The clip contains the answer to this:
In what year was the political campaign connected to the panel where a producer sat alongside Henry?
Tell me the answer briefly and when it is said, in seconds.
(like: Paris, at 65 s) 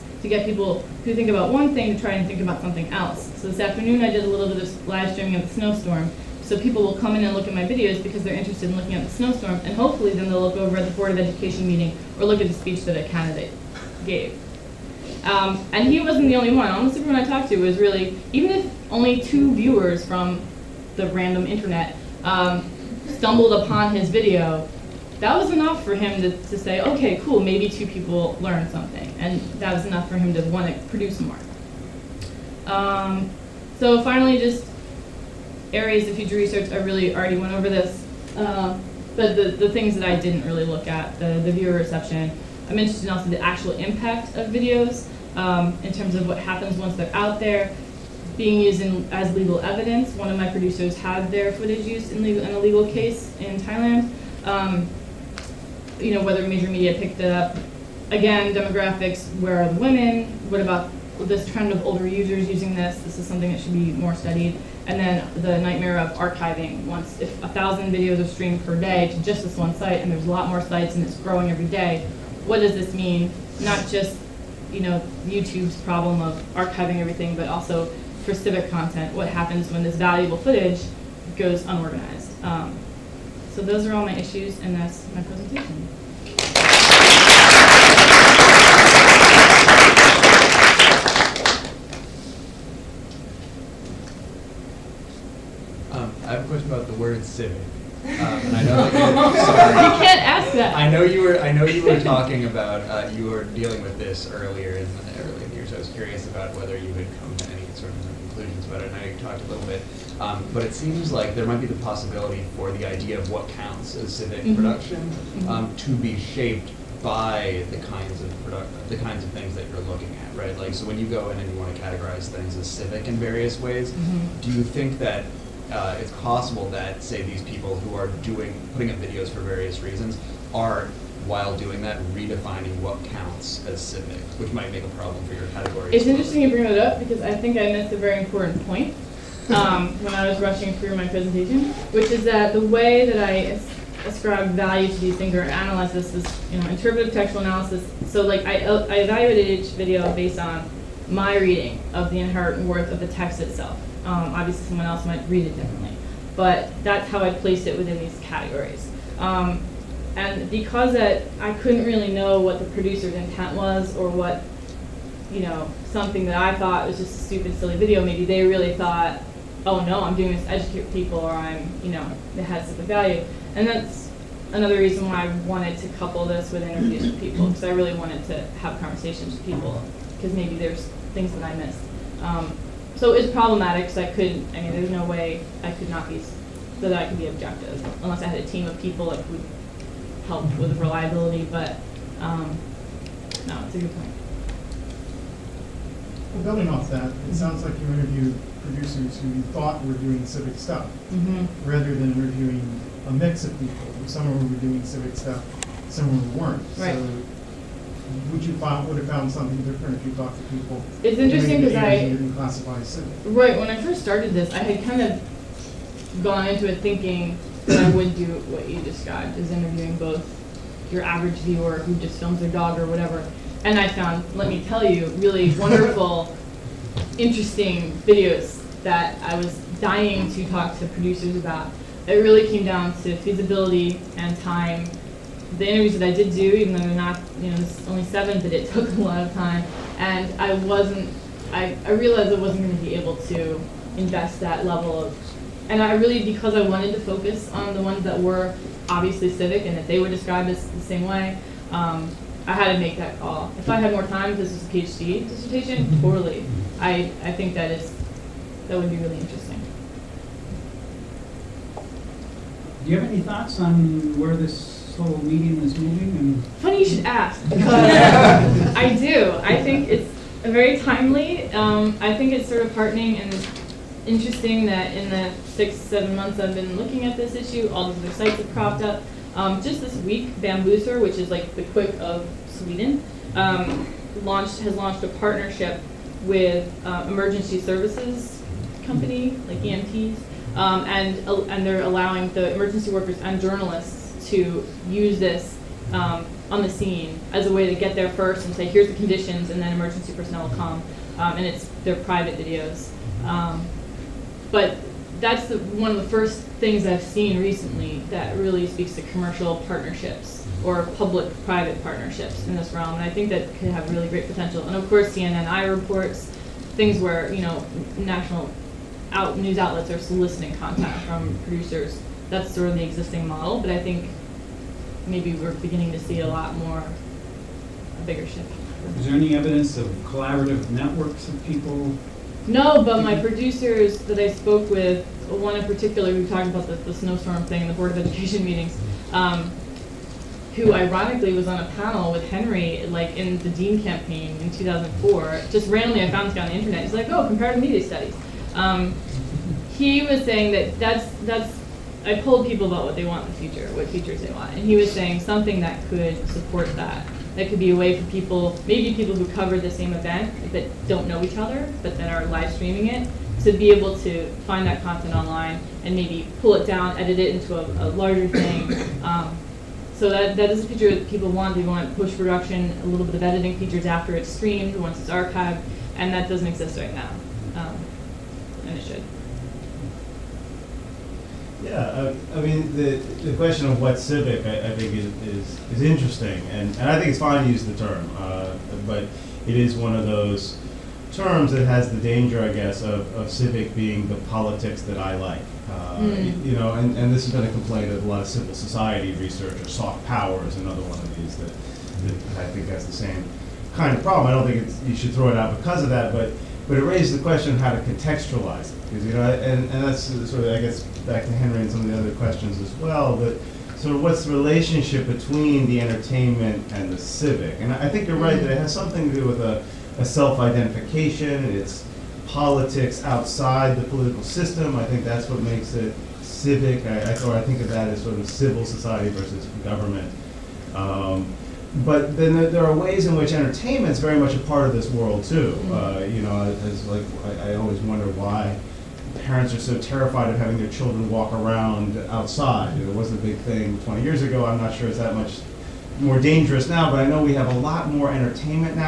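2004, at 344 s.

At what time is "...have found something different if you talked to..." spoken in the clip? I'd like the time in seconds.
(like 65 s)
208 s.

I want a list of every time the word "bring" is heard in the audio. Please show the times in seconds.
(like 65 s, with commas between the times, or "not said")
136 s.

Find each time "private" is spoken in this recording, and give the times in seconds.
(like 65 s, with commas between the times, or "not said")
301 s, 310 s.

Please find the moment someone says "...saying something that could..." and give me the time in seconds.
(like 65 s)
354 s.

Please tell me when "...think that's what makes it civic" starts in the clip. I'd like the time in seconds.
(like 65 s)
424 s.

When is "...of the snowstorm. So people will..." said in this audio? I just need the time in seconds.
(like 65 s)
5 s.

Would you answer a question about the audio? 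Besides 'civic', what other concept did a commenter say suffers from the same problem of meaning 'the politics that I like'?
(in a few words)
soft power.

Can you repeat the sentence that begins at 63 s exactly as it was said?
This is something that should be more studied.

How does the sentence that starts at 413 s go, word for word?
But sort of what's the relationship between the entertainment and the civic?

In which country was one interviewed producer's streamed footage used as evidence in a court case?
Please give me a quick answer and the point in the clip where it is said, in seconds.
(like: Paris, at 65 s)
Thailand, at 53 s.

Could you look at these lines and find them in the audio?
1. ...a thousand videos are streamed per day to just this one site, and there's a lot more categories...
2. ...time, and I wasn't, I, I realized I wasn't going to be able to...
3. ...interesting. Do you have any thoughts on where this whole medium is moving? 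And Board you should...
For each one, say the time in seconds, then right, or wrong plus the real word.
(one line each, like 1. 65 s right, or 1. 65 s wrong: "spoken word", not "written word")
1. 67 s wrong: "sites", not "categories"
2. 239 s right
3. 259 s wrong: "Funny", not "Board".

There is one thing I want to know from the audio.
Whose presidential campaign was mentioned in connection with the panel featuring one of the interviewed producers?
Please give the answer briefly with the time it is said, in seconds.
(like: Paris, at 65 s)
Dean, at 343 s.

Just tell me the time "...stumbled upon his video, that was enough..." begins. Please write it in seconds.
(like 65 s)
23 s.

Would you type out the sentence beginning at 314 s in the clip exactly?
And of course, CNN iReports things where you know national out news outlets are soliciting content from producers.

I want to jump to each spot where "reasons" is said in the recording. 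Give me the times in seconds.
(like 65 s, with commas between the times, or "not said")
129 s, 174 s.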